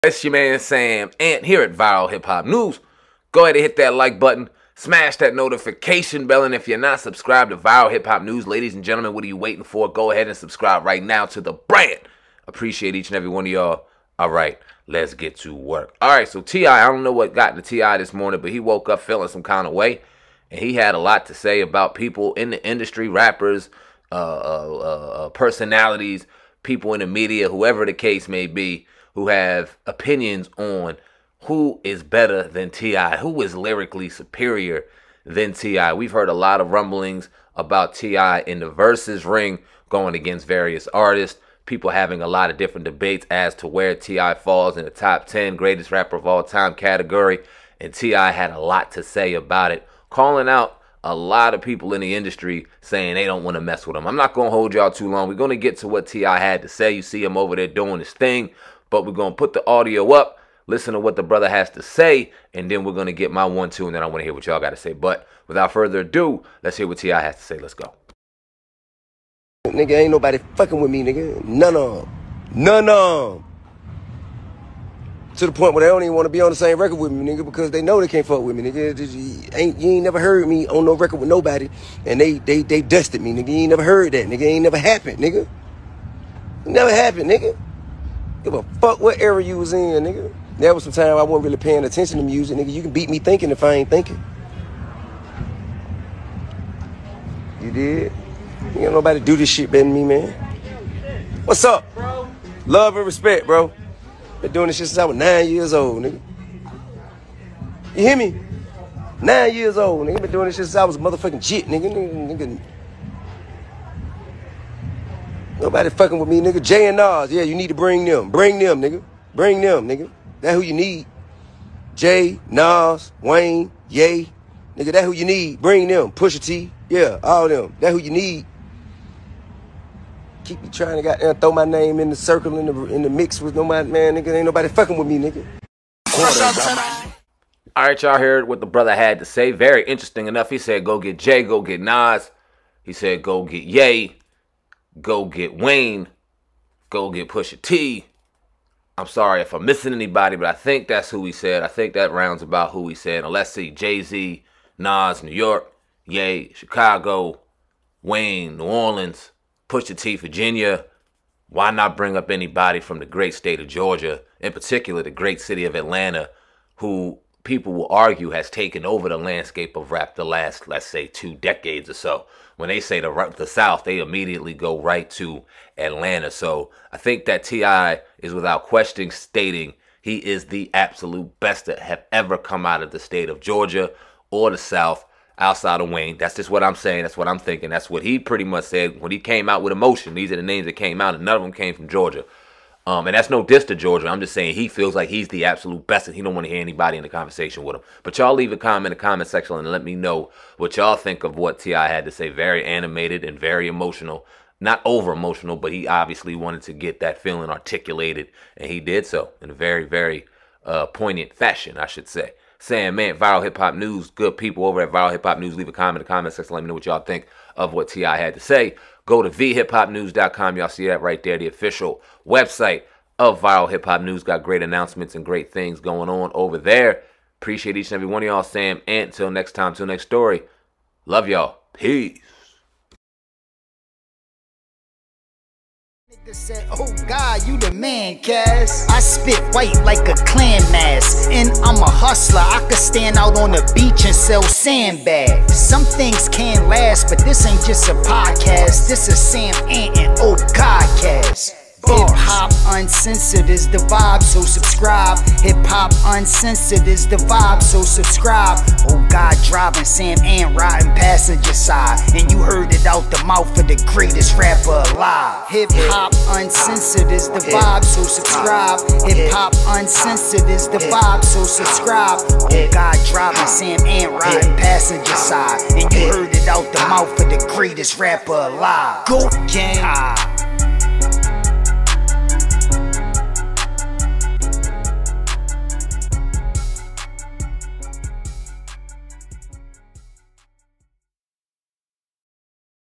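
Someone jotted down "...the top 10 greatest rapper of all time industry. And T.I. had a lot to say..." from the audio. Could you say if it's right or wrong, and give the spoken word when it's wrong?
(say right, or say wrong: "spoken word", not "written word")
wrong: "category", not "industry".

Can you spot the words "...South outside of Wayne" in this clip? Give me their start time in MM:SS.
03:04.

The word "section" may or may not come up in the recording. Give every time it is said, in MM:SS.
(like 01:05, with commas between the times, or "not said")
03:19, 03:36.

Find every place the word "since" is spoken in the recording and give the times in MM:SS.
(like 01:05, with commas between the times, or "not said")
01:44, 01:50.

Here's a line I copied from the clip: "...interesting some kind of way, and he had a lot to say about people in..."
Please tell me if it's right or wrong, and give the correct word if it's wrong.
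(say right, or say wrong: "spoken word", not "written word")
wrong: "feeling", not "interesting".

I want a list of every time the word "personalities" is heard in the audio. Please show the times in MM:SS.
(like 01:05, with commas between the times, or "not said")
00:25.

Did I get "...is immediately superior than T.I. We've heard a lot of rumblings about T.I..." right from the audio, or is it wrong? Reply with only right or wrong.
wrong.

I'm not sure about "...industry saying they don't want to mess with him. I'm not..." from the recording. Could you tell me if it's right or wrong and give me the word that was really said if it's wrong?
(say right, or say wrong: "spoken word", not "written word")
right.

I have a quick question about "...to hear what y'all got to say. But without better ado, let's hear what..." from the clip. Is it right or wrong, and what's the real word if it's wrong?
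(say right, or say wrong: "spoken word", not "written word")
wrong: "further", not "better".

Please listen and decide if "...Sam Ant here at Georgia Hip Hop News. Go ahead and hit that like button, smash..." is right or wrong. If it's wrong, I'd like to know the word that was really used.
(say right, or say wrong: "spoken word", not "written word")
wrong: "Viral", not "Georgia".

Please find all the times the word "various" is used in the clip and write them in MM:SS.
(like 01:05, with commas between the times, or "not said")
00:40.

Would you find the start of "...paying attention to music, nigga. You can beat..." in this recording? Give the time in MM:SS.
01:31.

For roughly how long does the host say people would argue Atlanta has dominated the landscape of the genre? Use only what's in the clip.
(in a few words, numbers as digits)
two decades.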